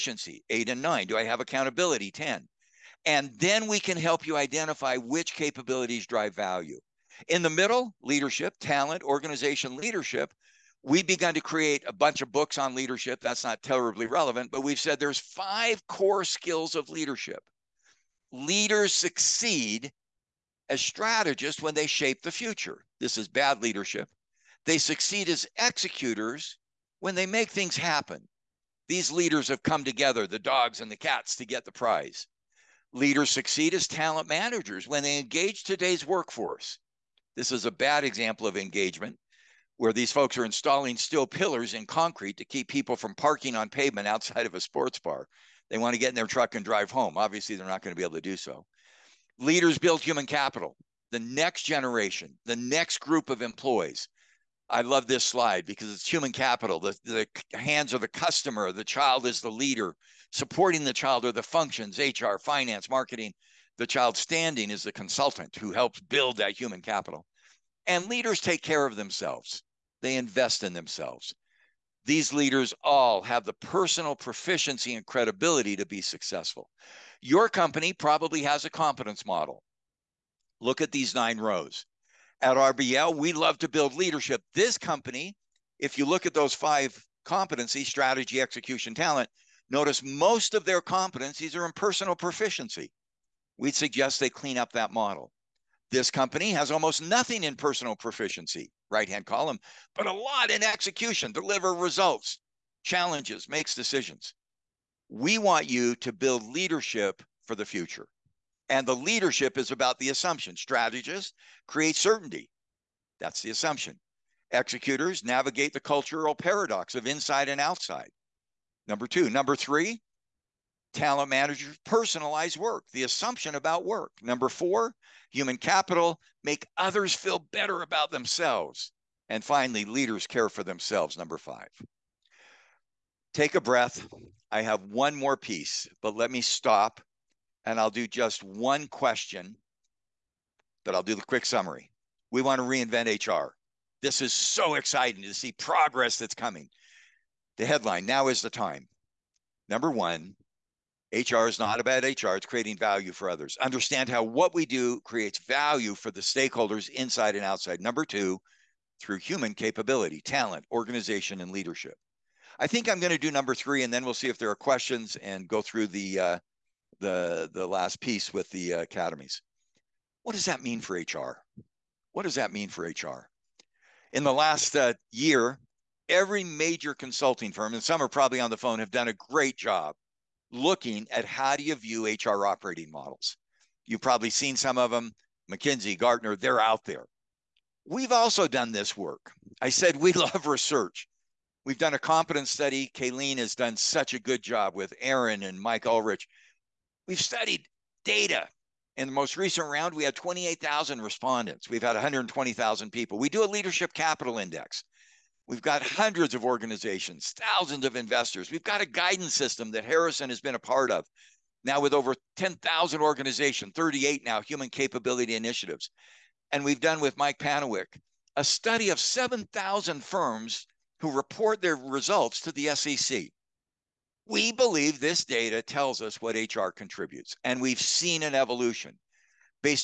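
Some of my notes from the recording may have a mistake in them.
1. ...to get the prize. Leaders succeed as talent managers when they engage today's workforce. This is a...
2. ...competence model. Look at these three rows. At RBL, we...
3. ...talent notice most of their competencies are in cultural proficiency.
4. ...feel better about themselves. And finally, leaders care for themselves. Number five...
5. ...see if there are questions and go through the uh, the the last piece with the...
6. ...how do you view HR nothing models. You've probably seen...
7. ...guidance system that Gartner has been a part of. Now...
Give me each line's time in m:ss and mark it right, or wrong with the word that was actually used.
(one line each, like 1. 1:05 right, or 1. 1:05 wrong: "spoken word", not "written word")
1. 0:31 right
2. 1:18 wrong: "nine", not "three"
3. 1:28 wrong: "personal", not "cultural"
4. 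2:07 right
5. 2:44 right
6. 3:01 wrong: "operating", not "nothing"
7. 3:28 wrong: "Harrison", not "Gartner".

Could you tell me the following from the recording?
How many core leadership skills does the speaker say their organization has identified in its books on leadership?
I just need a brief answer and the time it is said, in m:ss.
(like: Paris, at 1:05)
5, at 0:15.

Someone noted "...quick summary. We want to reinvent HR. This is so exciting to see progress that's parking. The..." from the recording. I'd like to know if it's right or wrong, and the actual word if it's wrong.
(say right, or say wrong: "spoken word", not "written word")
wrong: "coming", not "parking".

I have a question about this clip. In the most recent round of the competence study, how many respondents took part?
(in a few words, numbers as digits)
28,000.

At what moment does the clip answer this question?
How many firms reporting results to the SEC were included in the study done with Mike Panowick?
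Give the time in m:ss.
3:38.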